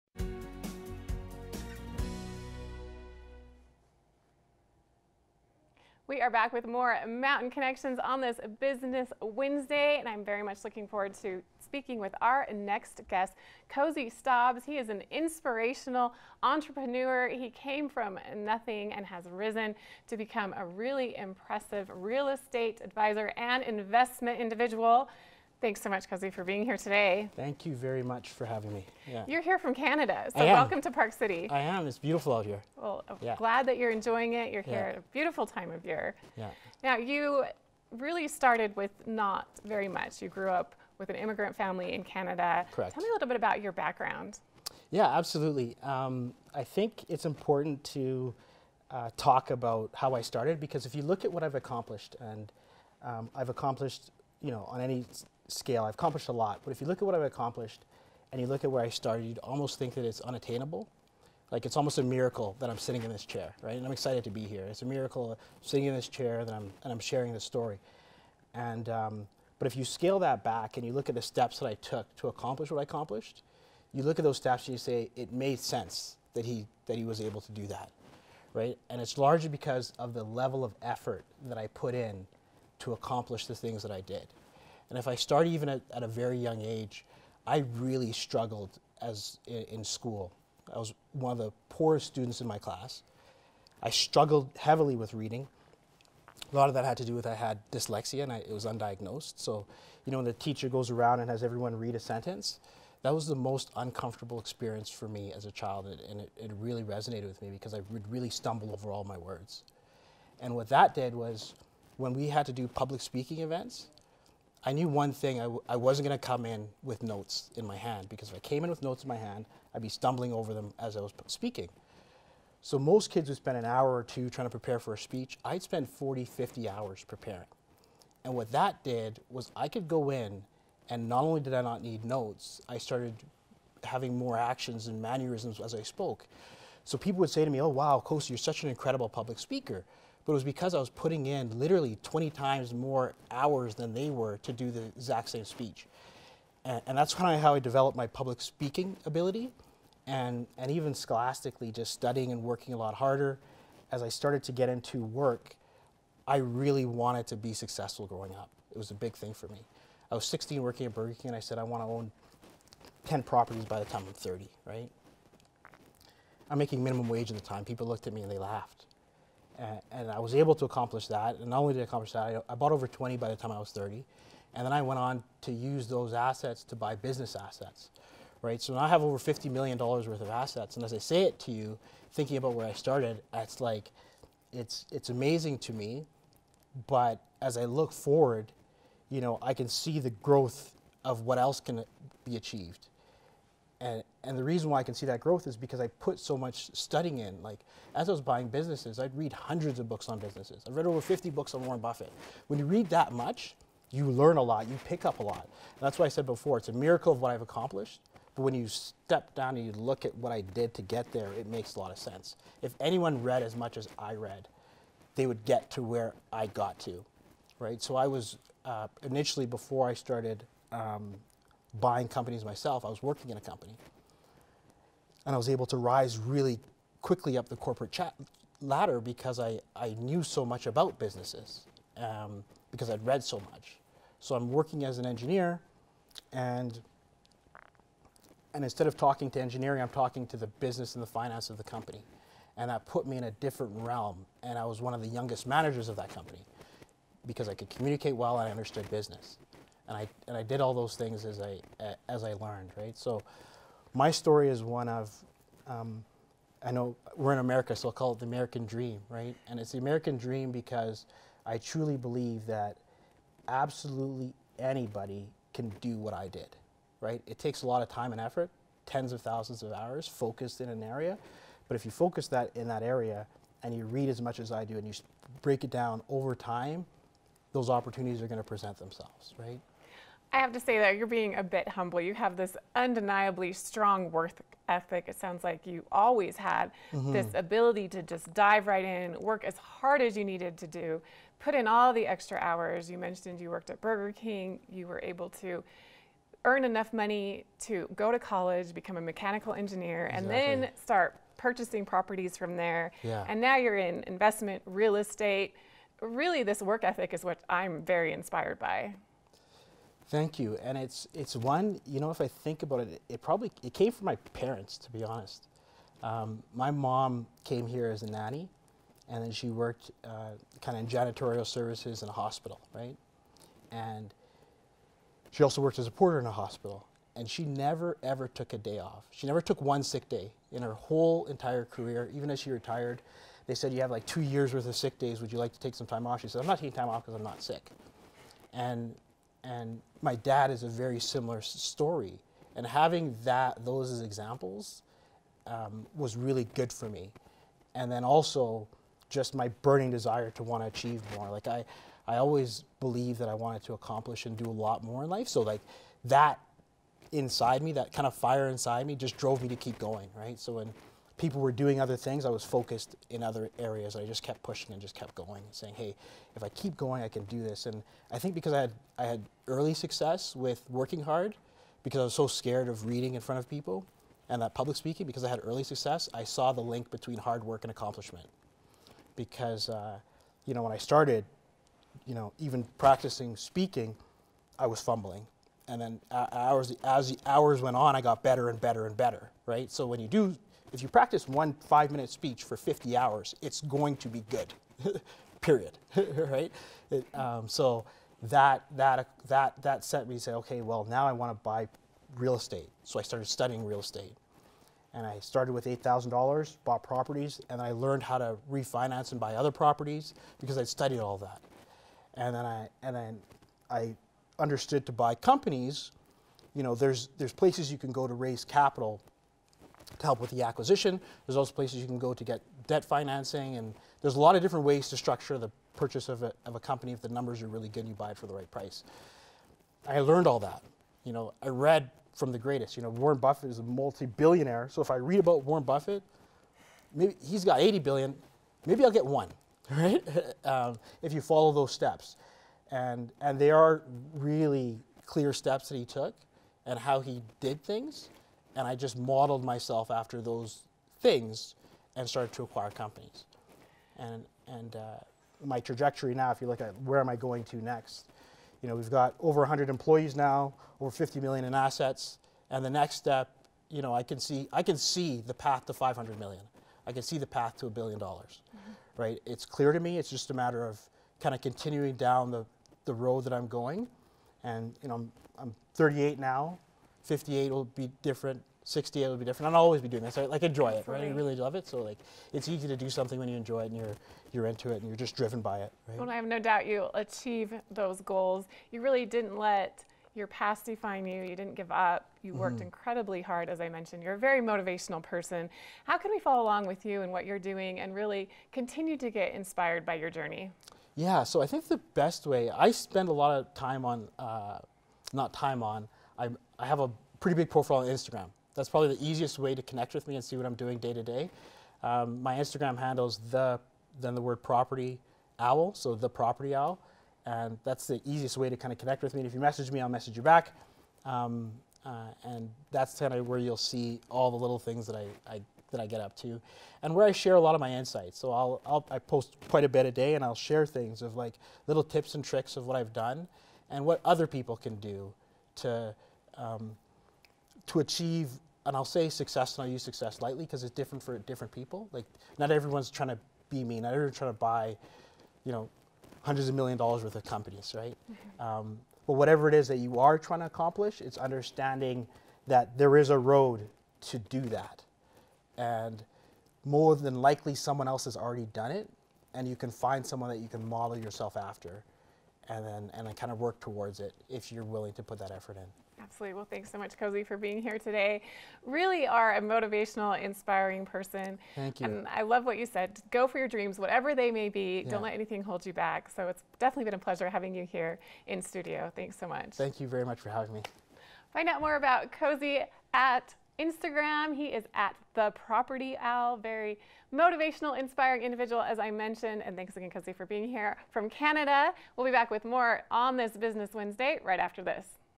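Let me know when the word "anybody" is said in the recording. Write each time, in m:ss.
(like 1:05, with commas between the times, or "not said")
4:24.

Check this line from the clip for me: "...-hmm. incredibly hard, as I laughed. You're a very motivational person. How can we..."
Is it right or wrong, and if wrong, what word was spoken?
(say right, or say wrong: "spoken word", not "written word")
wrong: "mentioned", not "laughed".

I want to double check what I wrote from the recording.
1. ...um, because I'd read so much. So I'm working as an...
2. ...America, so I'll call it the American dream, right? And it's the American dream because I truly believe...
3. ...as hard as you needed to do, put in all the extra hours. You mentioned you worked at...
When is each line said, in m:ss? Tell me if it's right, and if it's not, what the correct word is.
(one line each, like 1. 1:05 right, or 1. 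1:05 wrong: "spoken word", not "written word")
1. 3:51 right
2. 4:17 right
3. 4:49 right.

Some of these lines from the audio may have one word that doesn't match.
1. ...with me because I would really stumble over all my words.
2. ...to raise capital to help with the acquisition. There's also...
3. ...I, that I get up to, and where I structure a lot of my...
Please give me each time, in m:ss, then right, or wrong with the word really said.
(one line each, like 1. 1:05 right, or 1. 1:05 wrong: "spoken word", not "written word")
1. 1:47 right
2. 6:58 right
3. 8:45 wrong: "share", not "structure".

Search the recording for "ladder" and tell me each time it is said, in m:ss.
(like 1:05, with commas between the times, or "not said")
3:48.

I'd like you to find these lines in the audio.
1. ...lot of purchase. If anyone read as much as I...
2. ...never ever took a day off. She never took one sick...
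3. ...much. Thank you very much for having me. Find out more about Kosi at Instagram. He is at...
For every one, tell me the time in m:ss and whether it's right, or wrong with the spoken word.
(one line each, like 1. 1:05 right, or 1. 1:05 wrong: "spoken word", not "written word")
1. 3:31 wrong: "sense", not "purchase"
2. 5:27 right
3. 9:39 right.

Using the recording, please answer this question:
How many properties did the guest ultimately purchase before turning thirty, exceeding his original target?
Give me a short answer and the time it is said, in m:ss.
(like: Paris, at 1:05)
over 20, at 2:52.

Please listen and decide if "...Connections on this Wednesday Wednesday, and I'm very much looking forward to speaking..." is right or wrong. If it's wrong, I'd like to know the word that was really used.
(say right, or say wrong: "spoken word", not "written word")
wrong: "Business", not "Wednesday".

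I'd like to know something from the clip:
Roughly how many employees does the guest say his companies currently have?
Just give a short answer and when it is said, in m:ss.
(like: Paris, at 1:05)
over 100, at 7:39.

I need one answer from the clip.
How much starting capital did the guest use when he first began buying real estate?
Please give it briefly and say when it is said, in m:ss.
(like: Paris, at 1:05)
$8,000, at 6:45.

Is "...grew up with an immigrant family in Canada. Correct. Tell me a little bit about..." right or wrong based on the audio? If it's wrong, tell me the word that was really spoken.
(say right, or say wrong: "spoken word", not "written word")
right.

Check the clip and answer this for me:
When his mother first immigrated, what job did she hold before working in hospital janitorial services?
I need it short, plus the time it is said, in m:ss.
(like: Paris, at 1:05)
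nanny, at 5:18.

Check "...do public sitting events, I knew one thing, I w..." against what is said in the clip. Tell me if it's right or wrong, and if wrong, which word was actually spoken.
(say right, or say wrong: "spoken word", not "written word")
wrong: "speaking", not "sitting".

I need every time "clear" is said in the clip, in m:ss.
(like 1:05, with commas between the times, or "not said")
7:25, 7:49.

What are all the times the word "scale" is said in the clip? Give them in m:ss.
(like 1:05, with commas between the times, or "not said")
0:55, 1:09.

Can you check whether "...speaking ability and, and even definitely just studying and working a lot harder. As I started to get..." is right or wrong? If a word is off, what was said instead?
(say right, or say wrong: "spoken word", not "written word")
wrong: "scholastically", not "definitely".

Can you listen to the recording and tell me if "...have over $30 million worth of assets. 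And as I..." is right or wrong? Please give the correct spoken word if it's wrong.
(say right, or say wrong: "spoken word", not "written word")
wrong: "50", not "30".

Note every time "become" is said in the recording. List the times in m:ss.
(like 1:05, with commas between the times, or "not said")
0:20, 4:58.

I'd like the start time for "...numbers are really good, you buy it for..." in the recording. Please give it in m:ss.
7:07.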